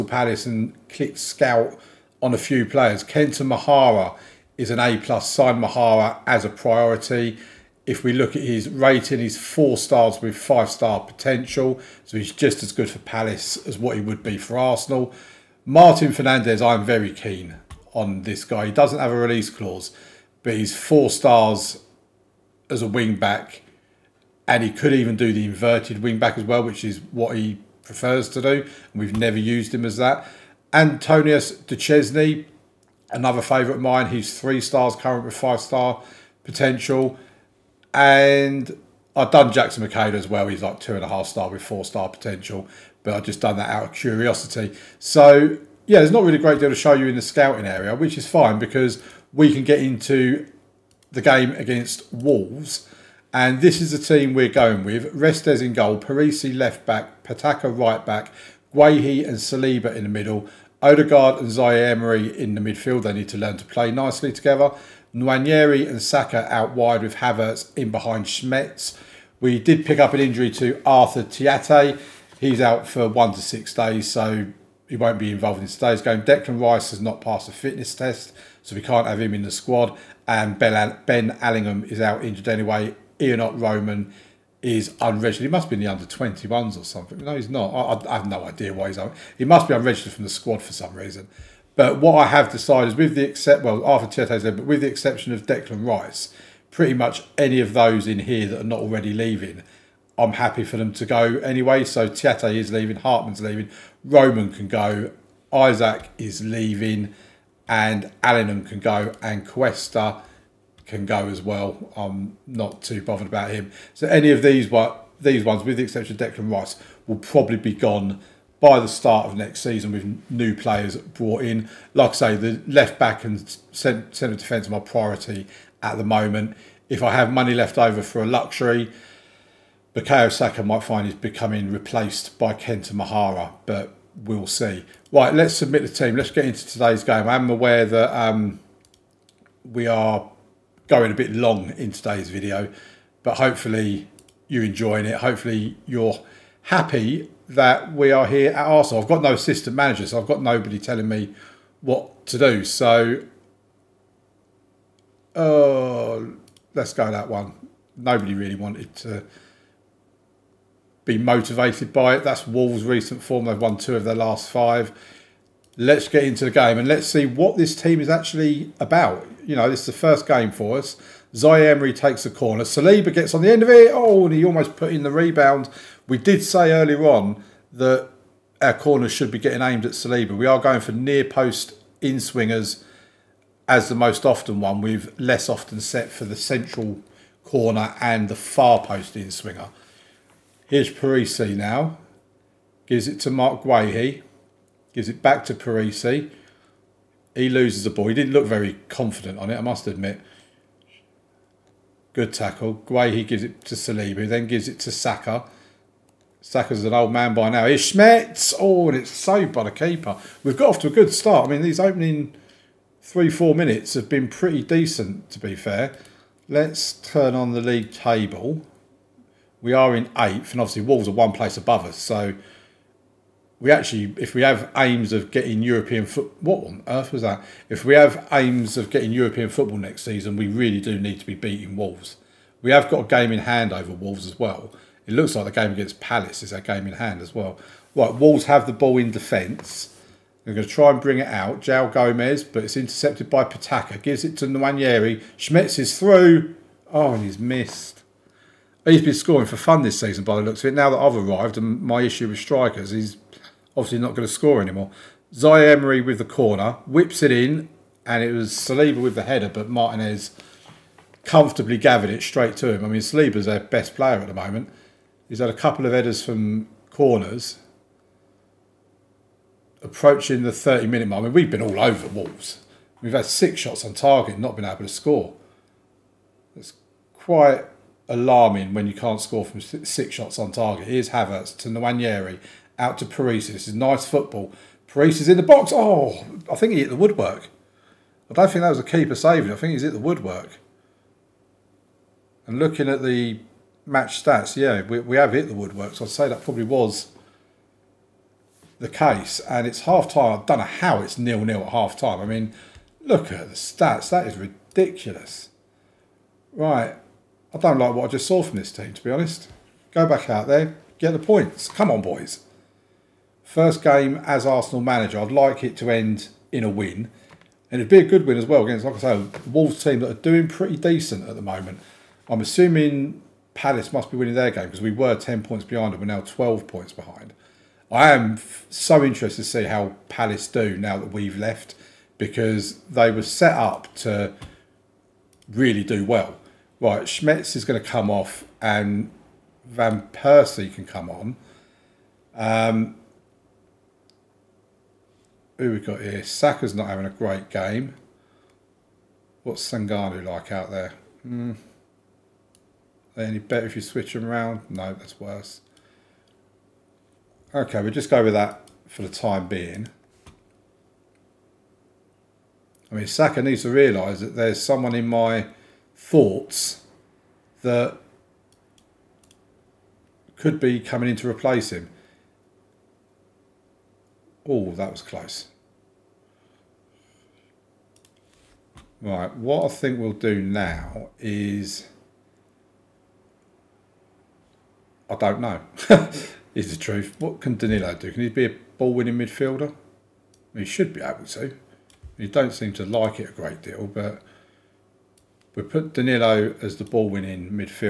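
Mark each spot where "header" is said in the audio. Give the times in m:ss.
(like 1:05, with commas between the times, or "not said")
4:19, 4:25.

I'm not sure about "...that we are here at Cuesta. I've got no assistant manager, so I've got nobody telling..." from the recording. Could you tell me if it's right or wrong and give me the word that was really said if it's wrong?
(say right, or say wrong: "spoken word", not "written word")
wrong: "Arsenal", not "Cuesta".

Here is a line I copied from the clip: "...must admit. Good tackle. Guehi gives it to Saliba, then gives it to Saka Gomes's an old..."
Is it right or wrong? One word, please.
wrong.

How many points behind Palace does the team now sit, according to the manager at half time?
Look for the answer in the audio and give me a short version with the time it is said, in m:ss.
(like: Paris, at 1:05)
12, at 5:26.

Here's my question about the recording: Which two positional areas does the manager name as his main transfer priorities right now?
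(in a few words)
Left back and centre defence.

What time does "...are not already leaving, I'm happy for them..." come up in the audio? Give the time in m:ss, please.
1:38.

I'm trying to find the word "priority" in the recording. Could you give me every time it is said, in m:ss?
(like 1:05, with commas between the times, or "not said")
0:06, 2:04.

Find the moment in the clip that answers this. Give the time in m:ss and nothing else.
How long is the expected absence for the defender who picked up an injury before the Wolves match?
1:13.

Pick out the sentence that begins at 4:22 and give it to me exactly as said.
I mean, Saliba's their best player at the moment.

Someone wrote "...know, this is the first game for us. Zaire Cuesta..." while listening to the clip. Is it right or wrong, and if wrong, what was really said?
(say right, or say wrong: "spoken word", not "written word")
wrong: "Emery", not "Cuesta".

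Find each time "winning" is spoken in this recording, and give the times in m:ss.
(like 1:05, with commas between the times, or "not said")
5:24, 6:28, 6:36.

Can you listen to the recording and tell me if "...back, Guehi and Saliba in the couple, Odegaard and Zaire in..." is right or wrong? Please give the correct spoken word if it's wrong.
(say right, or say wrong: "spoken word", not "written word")
wrong: "middle", not "couple".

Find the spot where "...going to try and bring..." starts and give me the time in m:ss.
4:00.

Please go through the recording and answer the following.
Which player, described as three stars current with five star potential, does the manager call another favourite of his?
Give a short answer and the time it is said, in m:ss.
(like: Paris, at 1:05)
Antonius De Chesney, at 0:30.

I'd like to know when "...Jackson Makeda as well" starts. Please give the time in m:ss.
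0:39.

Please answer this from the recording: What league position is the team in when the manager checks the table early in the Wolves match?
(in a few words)
8th.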